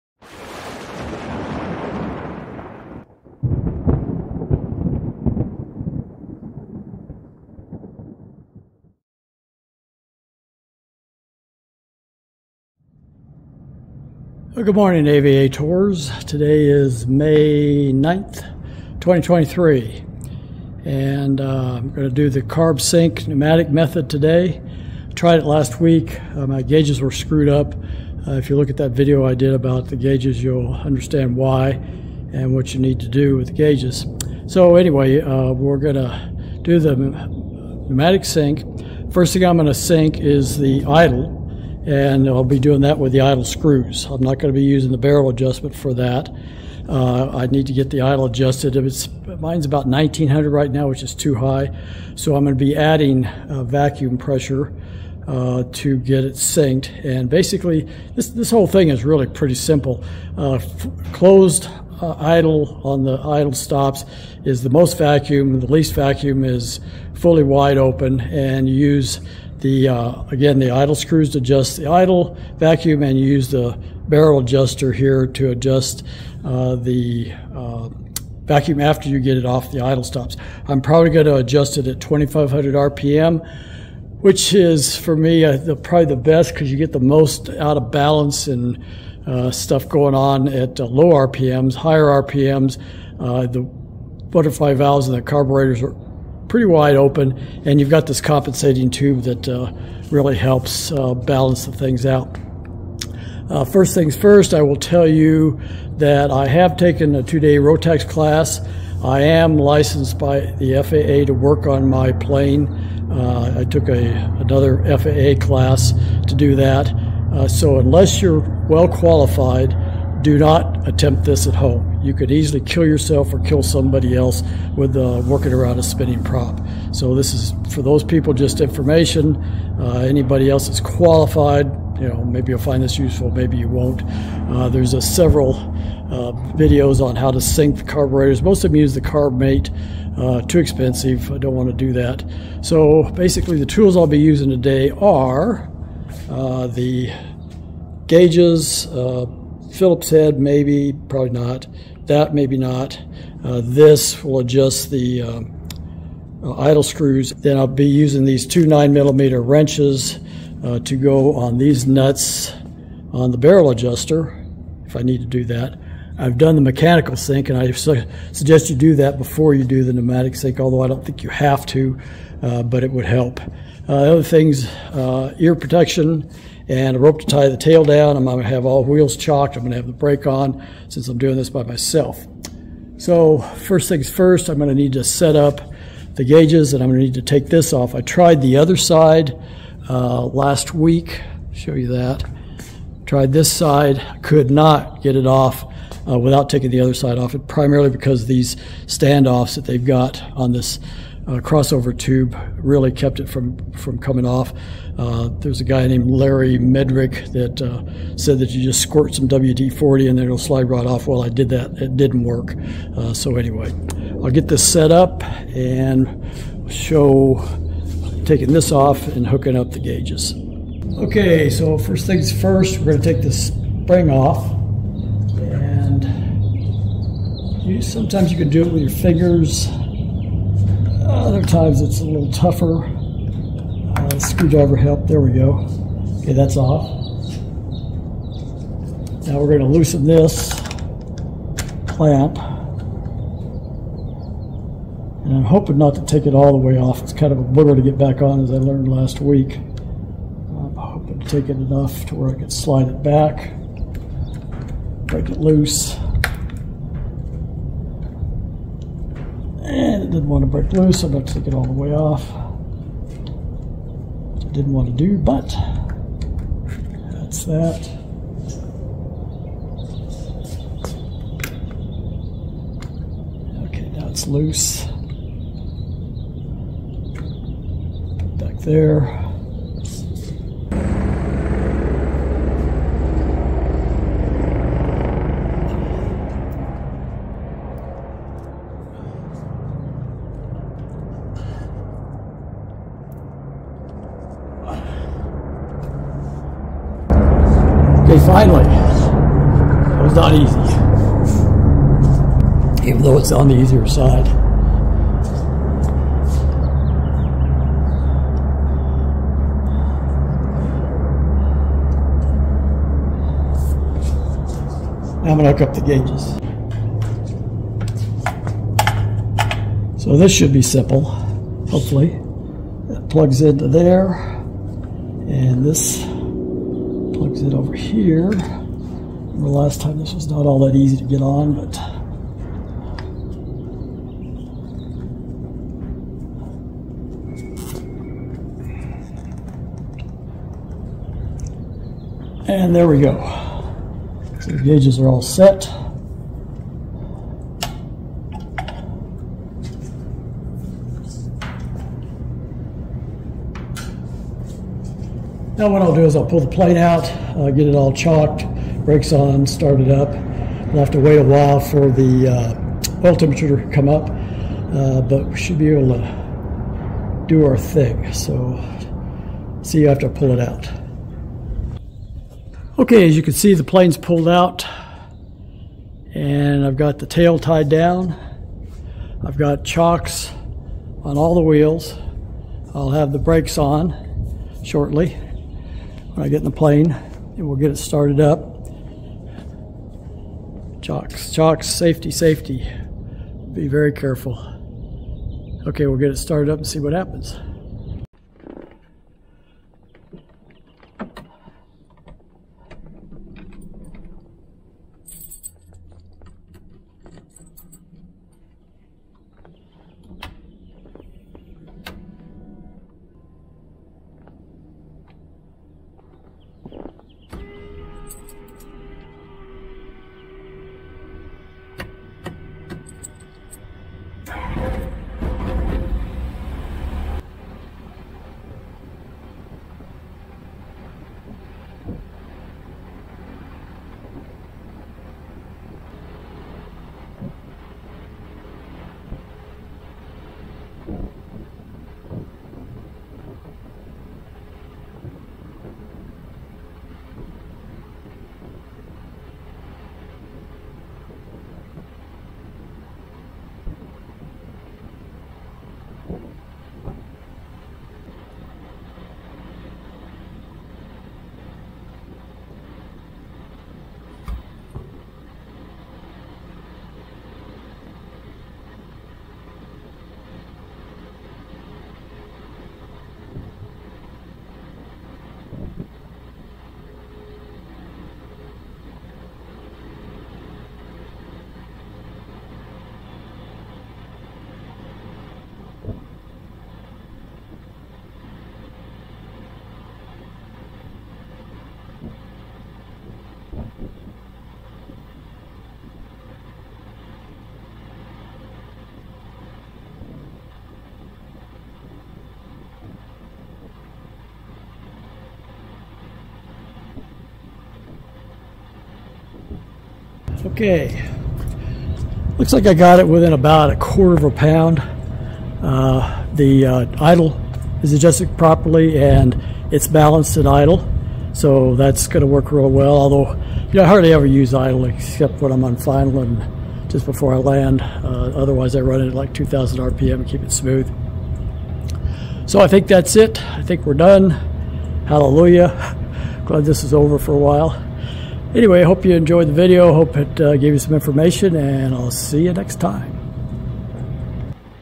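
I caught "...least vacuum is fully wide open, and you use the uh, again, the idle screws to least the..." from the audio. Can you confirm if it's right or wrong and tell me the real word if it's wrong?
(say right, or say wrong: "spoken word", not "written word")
wrong: "adjust", not "least".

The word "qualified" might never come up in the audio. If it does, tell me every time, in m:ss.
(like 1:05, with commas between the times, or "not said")
1:58, 2:10.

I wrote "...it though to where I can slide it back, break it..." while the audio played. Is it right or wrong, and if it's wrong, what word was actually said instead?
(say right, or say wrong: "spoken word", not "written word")
wrong: "enough", not "though".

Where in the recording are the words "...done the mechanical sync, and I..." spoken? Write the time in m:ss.
2:46.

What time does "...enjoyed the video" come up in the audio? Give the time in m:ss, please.
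8:59.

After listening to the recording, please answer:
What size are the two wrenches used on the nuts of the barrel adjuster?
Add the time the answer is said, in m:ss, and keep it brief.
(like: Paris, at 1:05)
9 millimeter, at 2:38.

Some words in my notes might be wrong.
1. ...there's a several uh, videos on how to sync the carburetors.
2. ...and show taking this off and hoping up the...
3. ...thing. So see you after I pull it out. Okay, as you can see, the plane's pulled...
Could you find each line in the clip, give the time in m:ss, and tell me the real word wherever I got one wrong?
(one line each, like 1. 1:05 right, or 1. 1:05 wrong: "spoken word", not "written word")
1. 2:14 right
2. 3:35 wrong: "hooking", not "hoping"
3. 6:07 right.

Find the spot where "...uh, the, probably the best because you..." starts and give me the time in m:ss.
1:25.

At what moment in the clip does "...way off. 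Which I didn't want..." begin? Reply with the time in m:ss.
4:21.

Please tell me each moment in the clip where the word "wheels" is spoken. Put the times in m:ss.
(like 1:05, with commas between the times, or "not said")
2:58, 6:21.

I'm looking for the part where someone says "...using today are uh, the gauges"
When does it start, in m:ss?
2:24.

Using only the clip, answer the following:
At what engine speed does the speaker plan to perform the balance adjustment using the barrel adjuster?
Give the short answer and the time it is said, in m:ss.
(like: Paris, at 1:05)
2,500 RPM, at 1:22.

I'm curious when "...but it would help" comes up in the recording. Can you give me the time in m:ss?
2:52.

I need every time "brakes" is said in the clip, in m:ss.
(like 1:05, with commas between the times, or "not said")
2:59, 5:58, 6:23.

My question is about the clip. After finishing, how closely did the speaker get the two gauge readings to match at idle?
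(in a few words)
a quarter of a pound.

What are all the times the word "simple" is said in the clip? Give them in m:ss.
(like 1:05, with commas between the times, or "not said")
0:59, 5:20.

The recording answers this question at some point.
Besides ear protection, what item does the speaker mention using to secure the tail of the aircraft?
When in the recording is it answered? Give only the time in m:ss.
2:56.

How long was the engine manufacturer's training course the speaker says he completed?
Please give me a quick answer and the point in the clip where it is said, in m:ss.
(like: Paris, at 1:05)
two-day, at 1:47.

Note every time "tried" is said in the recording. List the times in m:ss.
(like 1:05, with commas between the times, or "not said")
0:25, 3:08, 3:13.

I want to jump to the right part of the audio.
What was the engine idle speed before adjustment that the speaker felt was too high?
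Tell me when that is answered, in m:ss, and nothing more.
0:49.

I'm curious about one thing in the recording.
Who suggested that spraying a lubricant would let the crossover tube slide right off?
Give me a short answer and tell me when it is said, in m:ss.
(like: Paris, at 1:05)
Larry Medrick, at 3:26.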